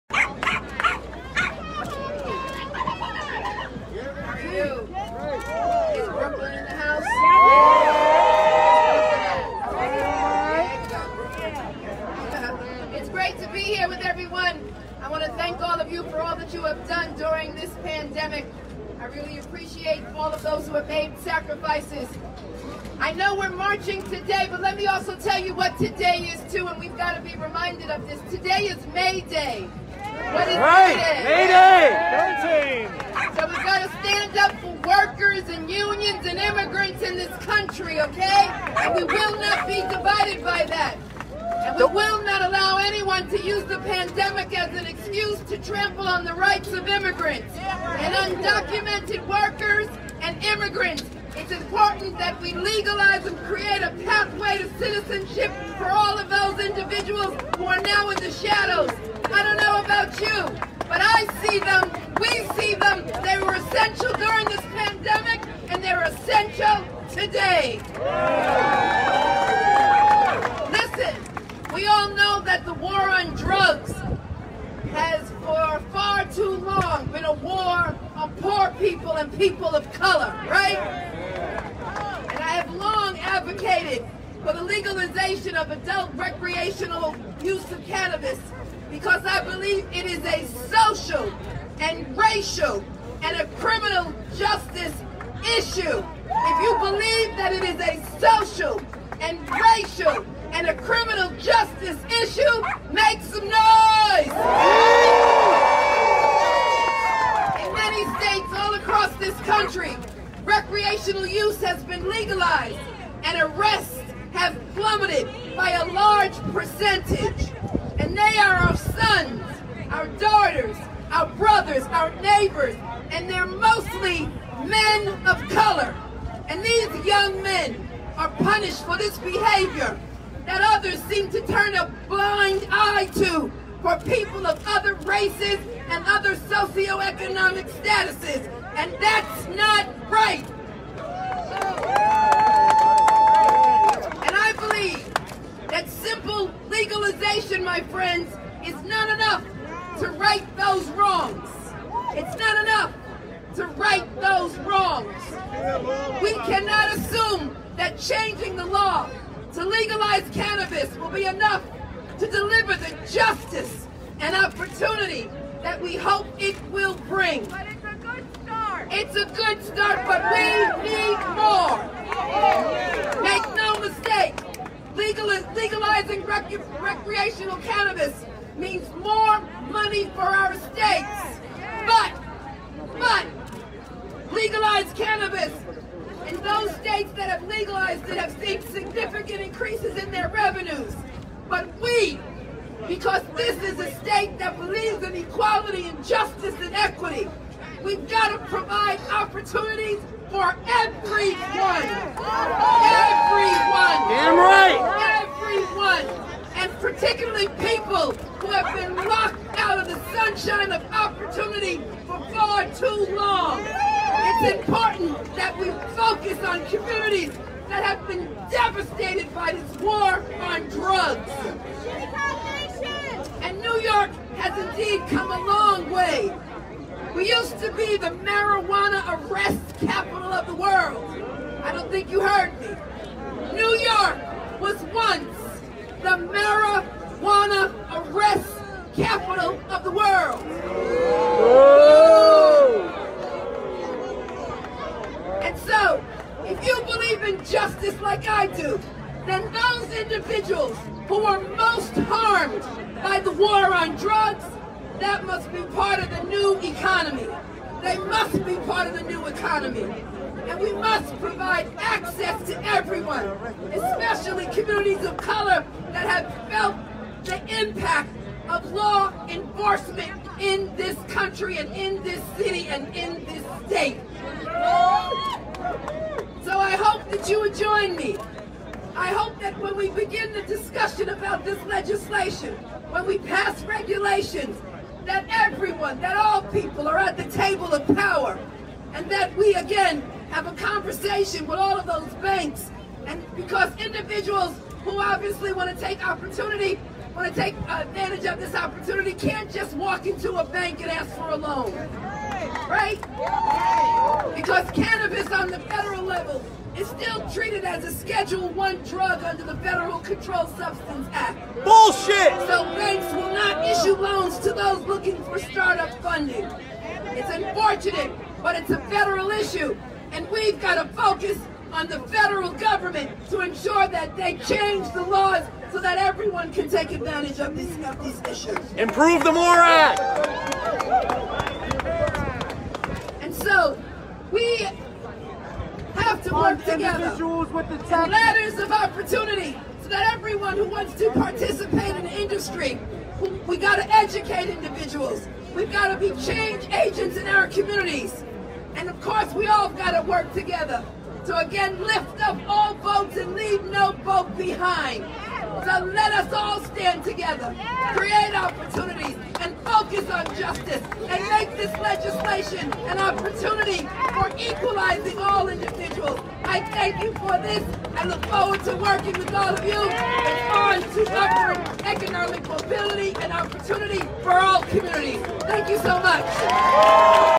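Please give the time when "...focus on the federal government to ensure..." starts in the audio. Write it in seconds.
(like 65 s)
320 s.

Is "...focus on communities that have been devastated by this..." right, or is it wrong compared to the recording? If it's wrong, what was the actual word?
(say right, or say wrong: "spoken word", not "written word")
right.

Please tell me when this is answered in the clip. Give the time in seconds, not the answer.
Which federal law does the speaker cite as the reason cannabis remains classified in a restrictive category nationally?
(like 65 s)
309 s.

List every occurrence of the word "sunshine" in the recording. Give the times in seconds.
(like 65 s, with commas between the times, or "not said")
210 s.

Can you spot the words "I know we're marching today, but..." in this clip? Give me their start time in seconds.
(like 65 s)
22 s.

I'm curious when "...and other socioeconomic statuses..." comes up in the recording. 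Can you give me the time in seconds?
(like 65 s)
135 s.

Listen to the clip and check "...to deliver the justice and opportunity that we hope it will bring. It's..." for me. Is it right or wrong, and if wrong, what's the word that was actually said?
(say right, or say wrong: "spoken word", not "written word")
right.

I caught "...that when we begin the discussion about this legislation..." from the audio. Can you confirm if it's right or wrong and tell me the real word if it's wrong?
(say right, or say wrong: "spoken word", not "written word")
right.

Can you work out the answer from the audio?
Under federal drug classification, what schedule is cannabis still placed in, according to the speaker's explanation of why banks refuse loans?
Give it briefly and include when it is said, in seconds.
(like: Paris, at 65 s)
Schedule One, at 307 s.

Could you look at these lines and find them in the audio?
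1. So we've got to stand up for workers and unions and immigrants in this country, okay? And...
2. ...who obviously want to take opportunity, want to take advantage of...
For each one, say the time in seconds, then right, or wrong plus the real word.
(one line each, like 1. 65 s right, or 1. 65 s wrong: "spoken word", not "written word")
1. 33 s right
2. 294 s right.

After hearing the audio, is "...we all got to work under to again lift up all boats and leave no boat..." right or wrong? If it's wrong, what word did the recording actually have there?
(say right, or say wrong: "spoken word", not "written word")
wrong: "together", not "under".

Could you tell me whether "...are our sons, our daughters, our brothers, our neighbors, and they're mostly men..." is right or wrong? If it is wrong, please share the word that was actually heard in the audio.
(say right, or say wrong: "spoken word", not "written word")
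right.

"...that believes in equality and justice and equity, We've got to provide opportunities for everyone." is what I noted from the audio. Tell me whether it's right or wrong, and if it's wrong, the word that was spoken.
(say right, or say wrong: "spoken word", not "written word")
right.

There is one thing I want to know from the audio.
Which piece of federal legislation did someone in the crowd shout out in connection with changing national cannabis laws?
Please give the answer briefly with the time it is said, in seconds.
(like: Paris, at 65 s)
MORE Act, at 329 s.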